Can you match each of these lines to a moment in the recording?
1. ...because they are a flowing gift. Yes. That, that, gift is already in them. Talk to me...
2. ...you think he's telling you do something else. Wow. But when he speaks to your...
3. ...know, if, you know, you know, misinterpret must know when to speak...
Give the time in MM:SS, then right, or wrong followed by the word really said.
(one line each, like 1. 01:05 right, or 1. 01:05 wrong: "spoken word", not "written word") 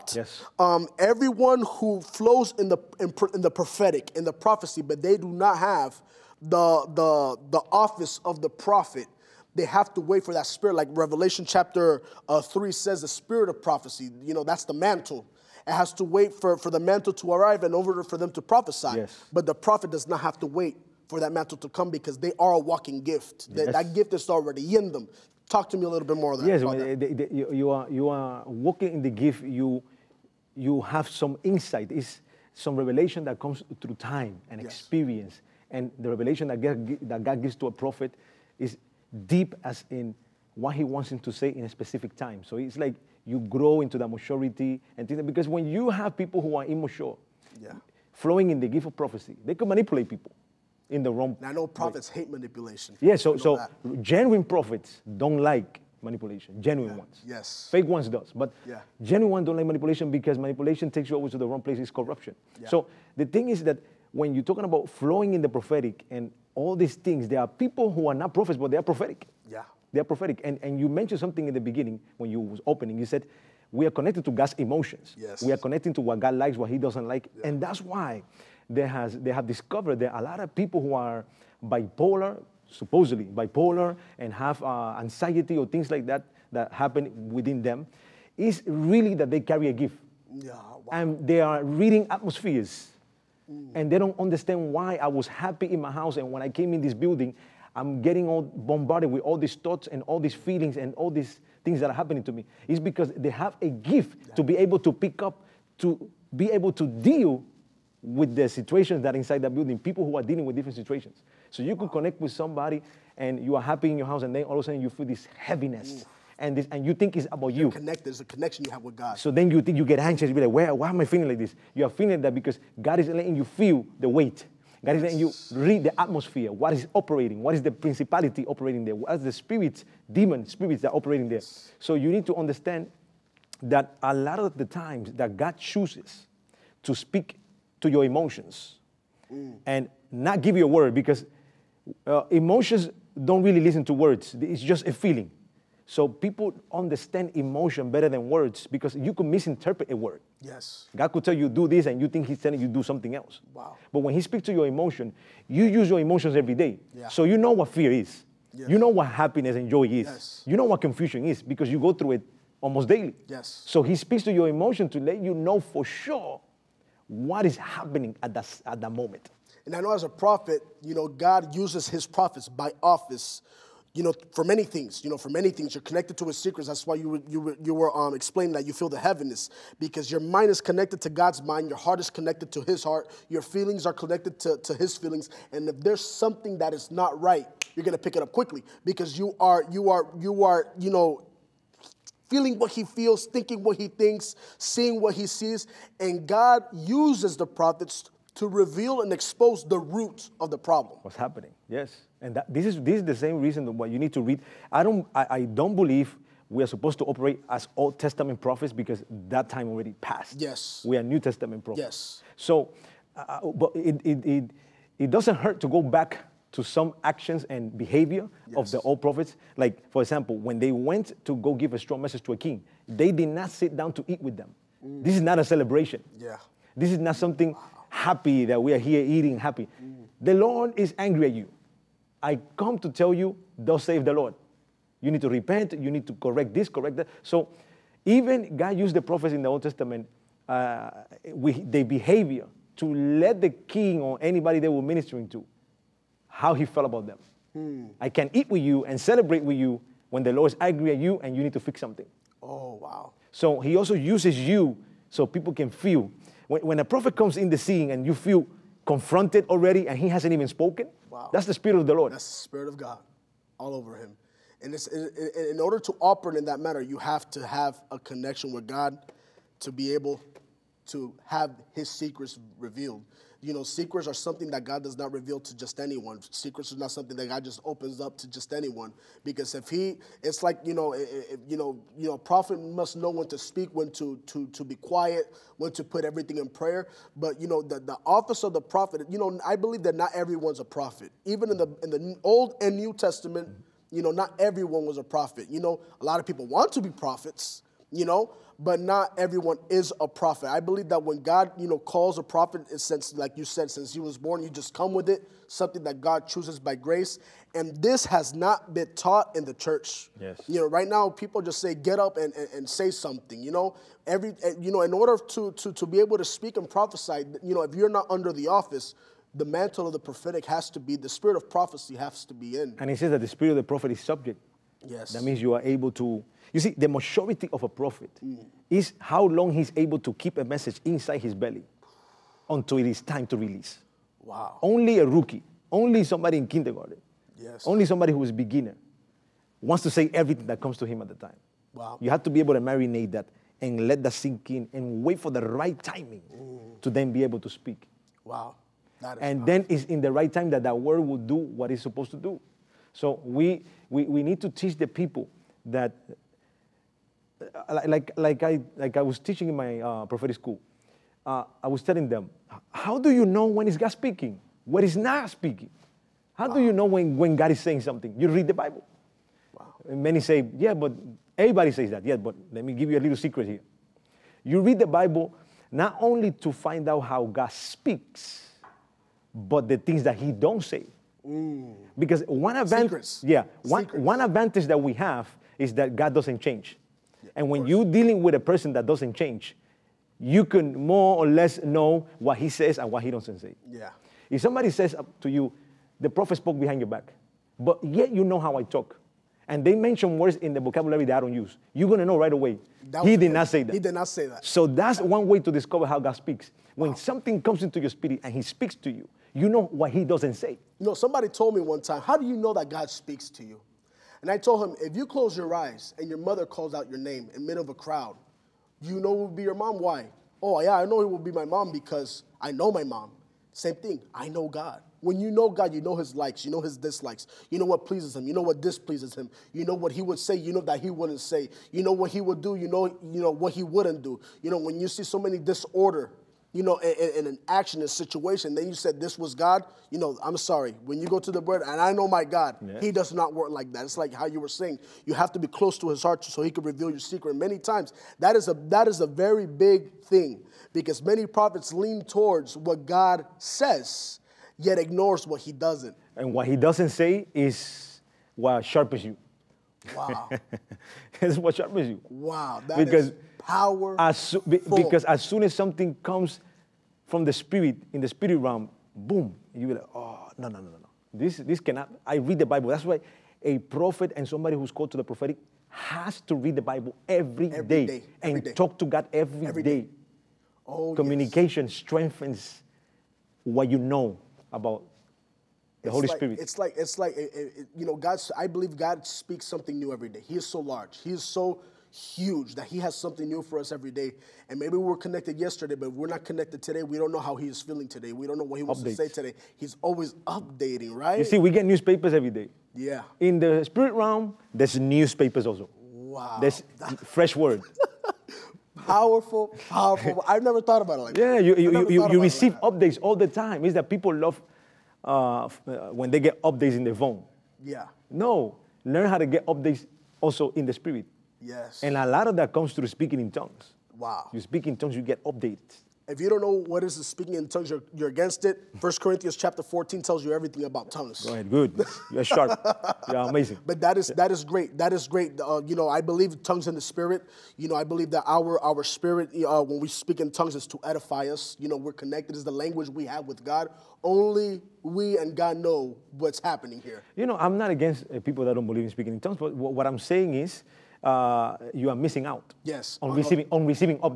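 1. 00:21 wrong: "walking", not "flowing"
2. 02:32 right
3. 04:40 wrong: "prophet", not "misinterpret".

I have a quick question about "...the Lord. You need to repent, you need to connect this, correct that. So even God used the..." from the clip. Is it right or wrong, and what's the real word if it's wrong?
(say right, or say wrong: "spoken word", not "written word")
wrong: "correct", not "connect".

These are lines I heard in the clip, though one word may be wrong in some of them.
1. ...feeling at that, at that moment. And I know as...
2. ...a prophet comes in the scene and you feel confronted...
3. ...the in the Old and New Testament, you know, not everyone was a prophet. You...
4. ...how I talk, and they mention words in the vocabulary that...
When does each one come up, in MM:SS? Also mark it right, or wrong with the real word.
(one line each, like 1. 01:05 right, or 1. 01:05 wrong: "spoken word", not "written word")
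1. 02:47 wrong: "happening", not "feeling"
2. 04:16 right
3. 04:51 right
4. 06:38 right.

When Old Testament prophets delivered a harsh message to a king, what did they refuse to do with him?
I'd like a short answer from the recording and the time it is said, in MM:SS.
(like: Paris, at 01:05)
Eat with them, at 03:43.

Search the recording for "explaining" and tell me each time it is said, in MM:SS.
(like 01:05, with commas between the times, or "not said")
02:58.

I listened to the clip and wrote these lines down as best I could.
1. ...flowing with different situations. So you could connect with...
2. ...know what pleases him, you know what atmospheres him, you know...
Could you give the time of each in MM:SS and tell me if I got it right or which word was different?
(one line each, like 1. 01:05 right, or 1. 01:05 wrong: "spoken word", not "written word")
1. 01:50 wrong: "dealing", not "flowing"
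2. 07:07 wrong: "displeases", not "atmospheres".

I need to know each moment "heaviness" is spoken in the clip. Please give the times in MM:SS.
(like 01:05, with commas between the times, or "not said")
01:55, 02:58.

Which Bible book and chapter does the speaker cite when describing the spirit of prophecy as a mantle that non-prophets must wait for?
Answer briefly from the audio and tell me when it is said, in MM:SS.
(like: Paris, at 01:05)
Revelation 3, at 00:10.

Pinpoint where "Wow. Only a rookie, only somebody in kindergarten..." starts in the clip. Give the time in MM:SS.
05:34.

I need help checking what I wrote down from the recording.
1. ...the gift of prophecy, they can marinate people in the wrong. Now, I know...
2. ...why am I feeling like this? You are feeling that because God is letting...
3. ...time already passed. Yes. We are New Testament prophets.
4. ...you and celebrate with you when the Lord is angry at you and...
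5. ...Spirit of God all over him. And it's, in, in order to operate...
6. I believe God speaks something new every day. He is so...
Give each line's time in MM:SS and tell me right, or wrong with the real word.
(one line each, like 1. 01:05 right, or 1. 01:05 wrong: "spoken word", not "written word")
1. 00:48 wrong: "manipulate", not "marinate"
2. 02:00 right
3. 03:29 right
4. 04:08 right
5. 04:22 right
6. 08:08 right.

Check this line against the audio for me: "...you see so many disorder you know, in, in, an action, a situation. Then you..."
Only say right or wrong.
right.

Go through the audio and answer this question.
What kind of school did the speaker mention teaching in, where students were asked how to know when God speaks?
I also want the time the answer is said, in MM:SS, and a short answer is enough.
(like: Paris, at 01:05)
Prophetic school, at 06:00.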